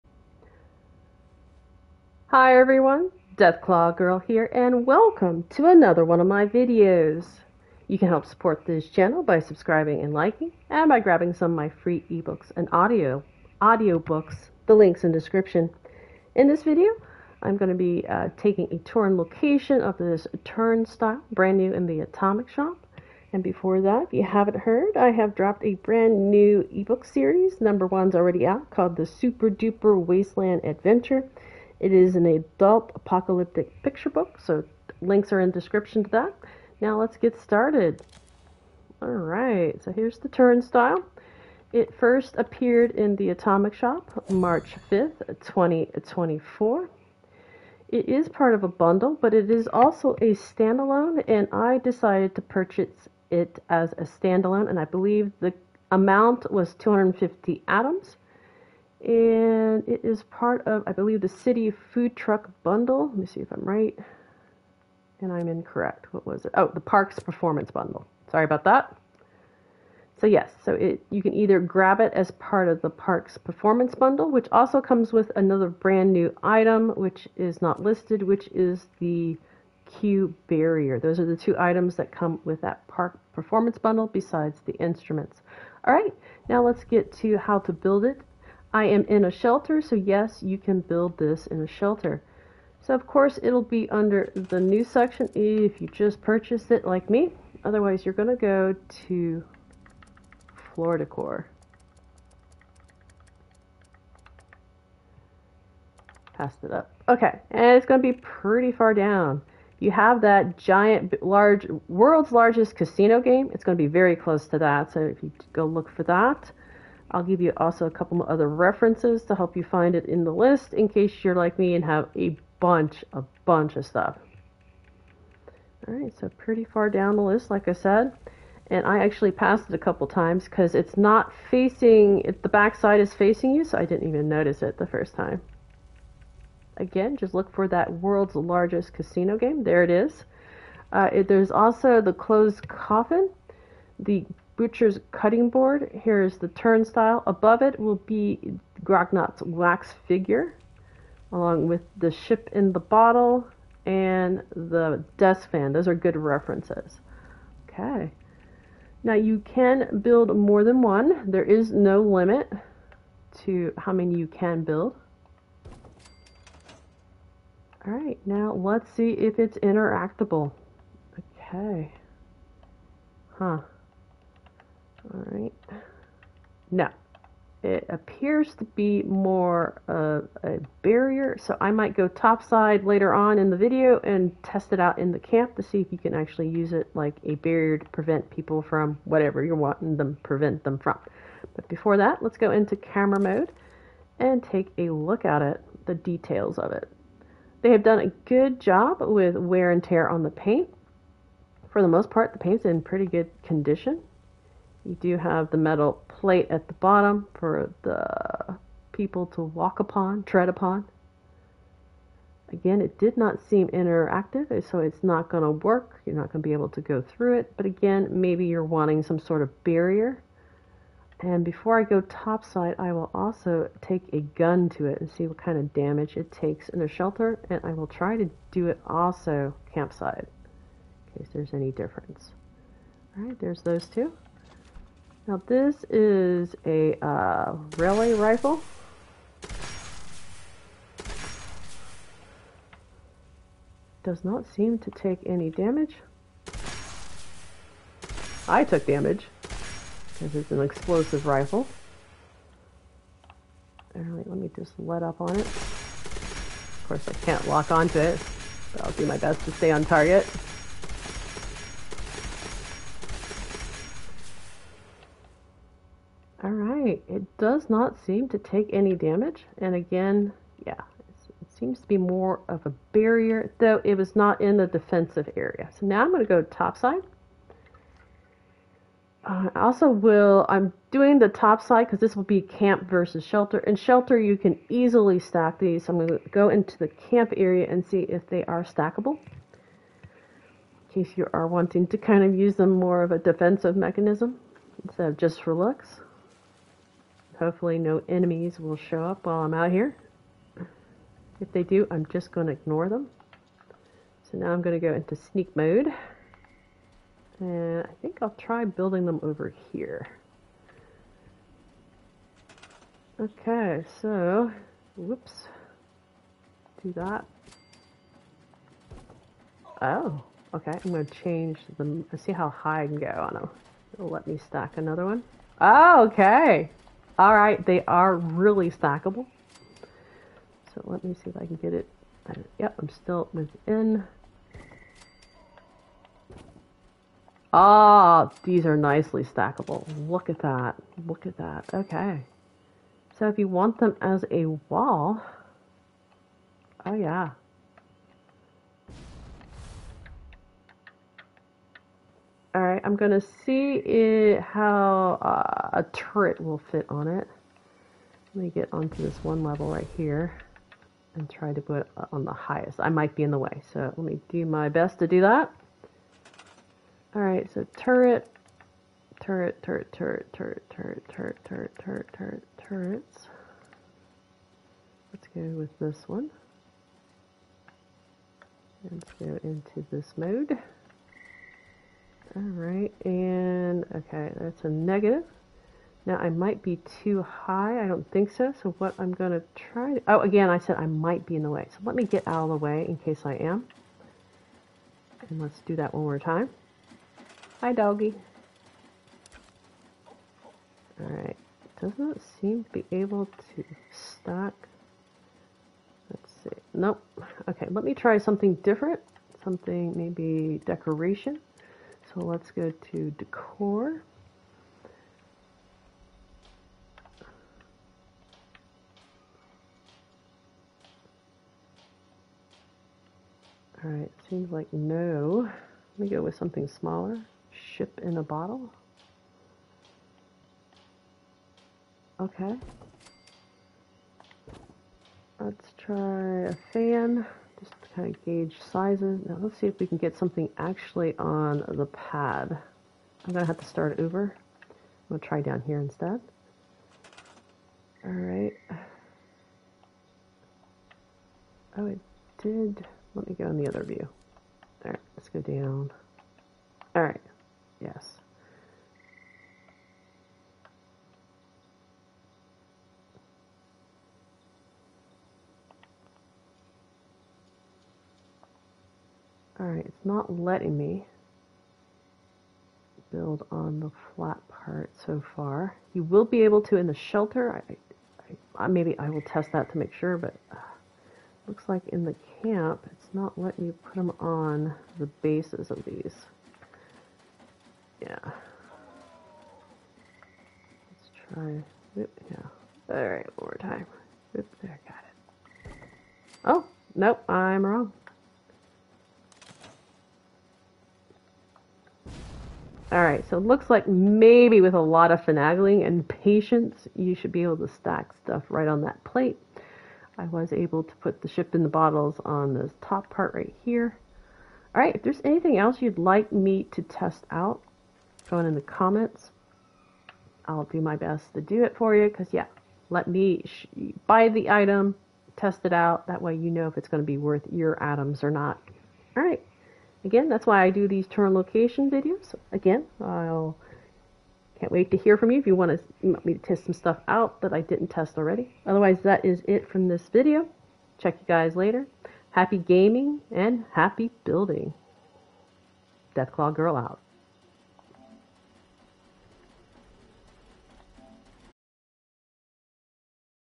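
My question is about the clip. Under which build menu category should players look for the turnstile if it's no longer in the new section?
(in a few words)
Floor decor.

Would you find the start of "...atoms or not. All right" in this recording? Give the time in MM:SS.
08:47.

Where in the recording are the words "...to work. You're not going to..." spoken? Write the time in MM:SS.
03:35.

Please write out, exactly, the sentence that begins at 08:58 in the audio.
Otherwise, that is it from this video.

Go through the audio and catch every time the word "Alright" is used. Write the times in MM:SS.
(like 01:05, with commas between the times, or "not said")
02:55, 04:13, 06:22, 06:41, 07:49.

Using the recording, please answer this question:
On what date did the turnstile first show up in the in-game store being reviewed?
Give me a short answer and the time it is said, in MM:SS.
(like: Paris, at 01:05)
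March 5th, 2024, at 00:44.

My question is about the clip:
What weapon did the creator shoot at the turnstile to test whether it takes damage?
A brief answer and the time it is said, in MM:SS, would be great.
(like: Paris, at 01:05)
Railway rifle, at 03:57.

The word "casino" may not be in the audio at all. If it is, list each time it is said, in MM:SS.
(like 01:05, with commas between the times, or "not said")
01:52, 02:18.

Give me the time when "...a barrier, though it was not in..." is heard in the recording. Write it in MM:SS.
04:32.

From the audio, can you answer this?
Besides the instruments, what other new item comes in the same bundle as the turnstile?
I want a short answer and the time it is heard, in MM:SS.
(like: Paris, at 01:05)
Queue barrier, at 01:19.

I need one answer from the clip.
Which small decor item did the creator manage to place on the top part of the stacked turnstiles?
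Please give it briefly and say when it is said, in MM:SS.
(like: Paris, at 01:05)
Ship in a bottle, at 07:07.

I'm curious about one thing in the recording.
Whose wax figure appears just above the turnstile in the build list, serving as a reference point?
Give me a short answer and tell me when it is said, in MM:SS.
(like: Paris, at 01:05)
Grognak's, at 02:28.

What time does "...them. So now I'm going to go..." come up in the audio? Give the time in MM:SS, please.
05:02.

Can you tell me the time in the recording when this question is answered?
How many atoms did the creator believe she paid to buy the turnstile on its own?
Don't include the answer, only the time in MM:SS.
00:56.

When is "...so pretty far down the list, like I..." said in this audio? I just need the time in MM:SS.
02:06.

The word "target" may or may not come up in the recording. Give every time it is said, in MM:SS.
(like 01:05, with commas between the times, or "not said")
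04:19.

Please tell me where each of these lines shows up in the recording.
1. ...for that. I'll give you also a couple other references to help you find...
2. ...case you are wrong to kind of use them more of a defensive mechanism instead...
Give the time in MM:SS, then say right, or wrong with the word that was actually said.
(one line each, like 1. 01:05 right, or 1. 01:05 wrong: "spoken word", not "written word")
1. 01:55 right
2. 04:51 wrong: "wanting", not "wrong".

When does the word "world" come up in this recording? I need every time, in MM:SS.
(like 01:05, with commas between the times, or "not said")
01:51, 02:17.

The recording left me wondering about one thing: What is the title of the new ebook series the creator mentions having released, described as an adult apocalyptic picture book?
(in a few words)
The Super Duper Wasteland Adventure.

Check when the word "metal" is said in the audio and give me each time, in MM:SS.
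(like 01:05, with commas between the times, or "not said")
03:25.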